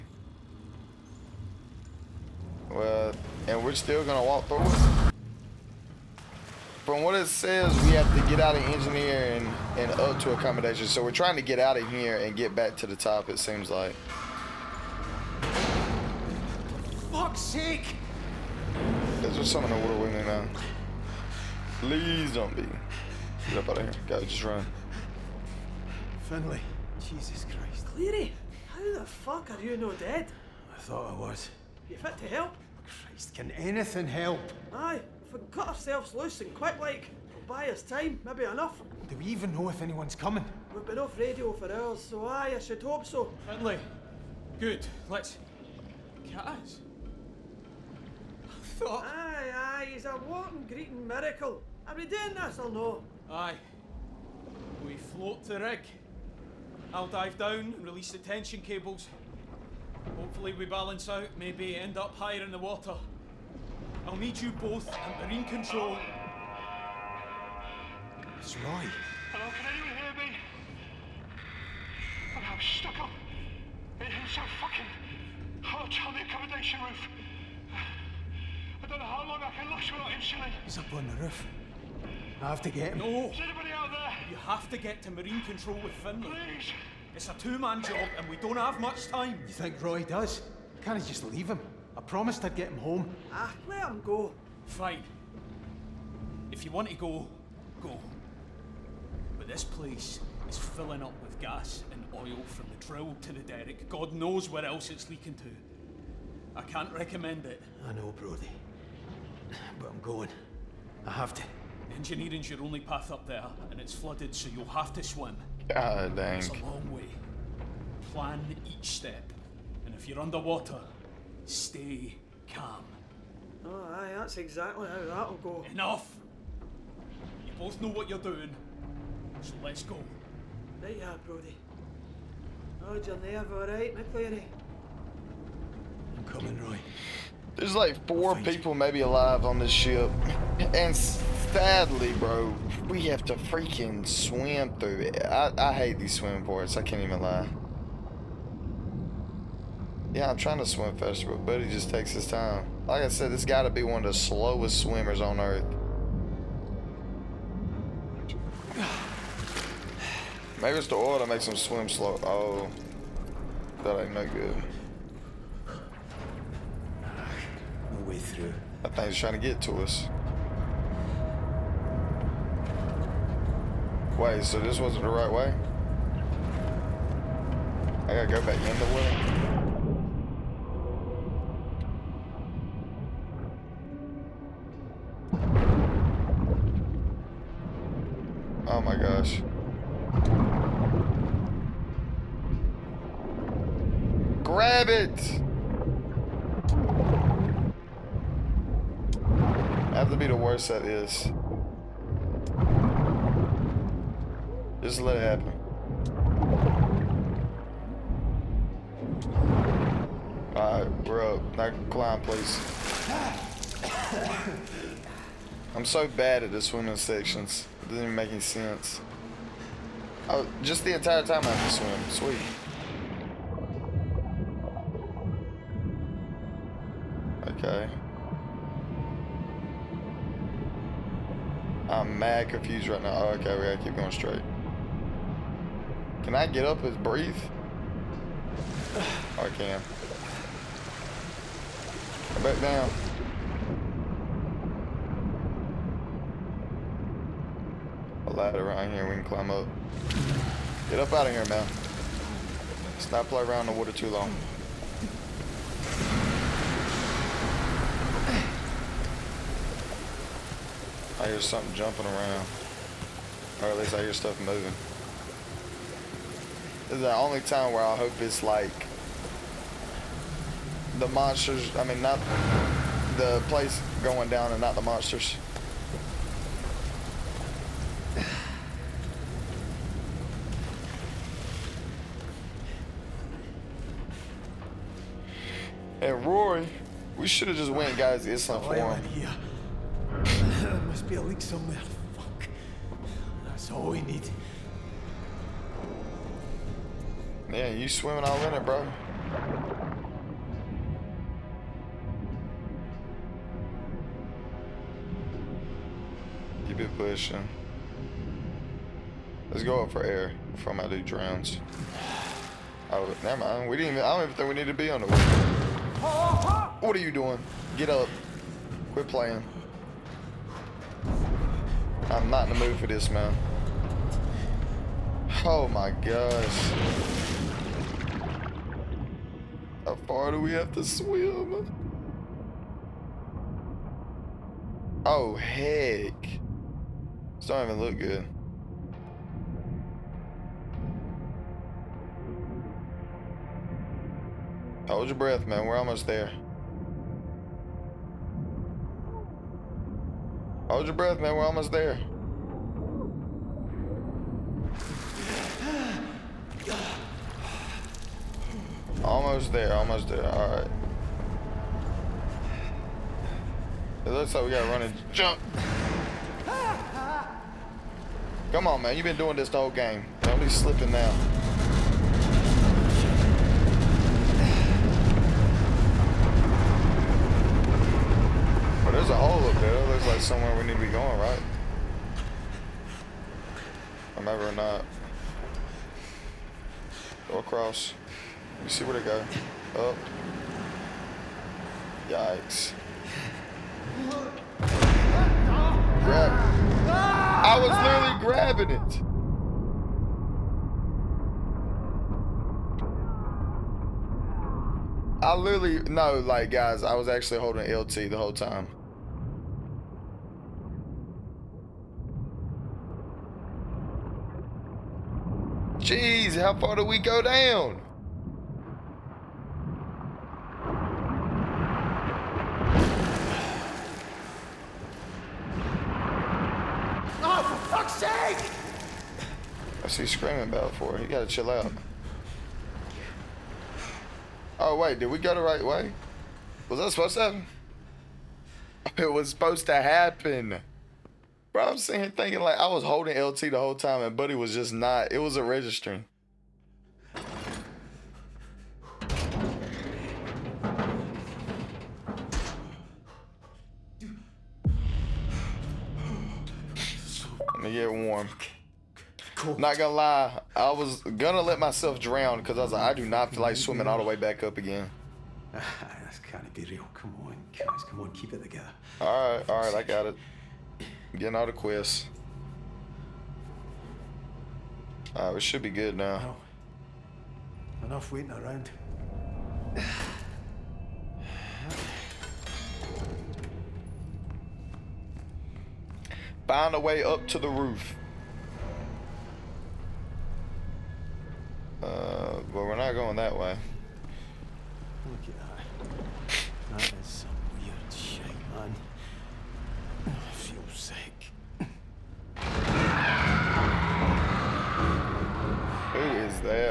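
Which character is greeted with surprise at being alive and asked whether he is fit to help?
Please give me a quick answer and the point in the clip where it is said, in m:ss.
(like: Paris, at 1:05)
Cleary, at 0:27.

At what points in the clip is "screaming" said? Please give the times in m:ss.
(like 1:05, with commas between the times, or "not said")
7:10.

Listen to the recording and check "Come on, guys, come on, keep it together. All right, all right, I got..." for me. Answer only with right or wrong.
right.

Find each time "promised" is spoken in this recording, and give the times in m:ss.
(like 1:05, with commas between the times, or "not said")
1:32.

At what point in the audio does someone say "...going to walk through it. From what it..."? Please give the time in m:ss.
0:04.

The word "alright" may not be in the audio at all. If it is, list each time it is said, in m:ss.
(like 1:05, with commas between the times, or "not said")
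2:13, 3:30, 7:55.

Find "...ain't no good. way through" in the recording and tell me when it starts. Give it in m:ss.
2:44.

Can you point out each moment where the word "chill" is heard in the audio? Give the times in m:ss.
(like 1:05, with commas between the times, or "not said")
7:11.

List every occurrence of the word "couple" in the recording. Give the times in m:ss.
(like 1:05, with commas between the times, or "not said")
not said.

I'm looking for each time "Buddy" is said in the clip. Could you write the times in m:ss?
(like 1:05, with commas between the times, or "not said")
2:31, 7:24.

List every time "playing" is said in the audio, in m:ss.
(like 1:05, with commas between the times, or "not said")
4:13, 5:19.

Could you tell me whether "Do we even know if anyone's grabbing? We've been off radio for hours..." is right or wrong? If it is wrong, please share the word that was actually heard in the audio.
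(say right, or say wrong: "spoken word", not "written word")
wrong: "coming", not "grabbing".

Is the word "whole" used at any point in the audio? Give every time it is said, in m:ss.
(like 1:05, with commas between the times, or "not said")
6:09, 6:48, 7:23.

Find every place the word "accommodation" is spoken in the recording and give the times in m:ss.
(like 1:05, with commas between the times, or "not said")
0:10, 1:16.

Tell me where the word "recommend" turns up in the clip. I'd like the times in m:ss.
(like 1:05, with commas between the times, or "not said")
1:46.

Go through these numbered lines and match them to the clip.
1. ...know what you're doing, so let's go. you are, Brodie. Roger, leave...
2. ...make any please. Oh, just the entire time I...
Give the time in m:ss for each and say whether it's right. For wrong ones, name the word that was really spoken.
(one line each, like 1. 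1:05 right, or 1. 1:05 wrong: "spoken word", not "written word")
1. 2:07 wrong: "nerve", not "leave"
2. 3:38 wrong: "sense", not "please".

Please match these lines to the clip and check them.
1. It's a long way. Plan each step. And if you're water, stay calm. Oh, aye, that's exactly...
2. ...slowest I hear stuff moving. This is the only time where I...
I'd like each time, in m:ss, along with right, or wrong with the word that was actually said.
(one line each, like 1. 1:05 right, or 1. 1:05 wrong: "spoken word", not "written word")
1. 1:56 wrong: "underwater", not "water"
2. 4:23 wrong: "least", not "slowest".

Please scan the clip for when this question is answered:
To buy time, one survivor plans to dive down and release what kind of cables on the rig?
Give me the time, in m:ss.
0:58.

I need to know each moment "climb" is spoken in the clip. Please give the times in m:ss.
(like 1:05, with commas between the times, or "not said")
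3:31, 4:09.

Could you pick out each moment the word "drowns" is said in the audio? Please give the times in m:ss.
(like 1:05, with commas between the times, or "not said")
5:11, 7:41.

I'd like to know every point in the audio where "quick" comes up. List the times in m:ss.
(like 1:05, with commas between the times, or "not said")
0:36.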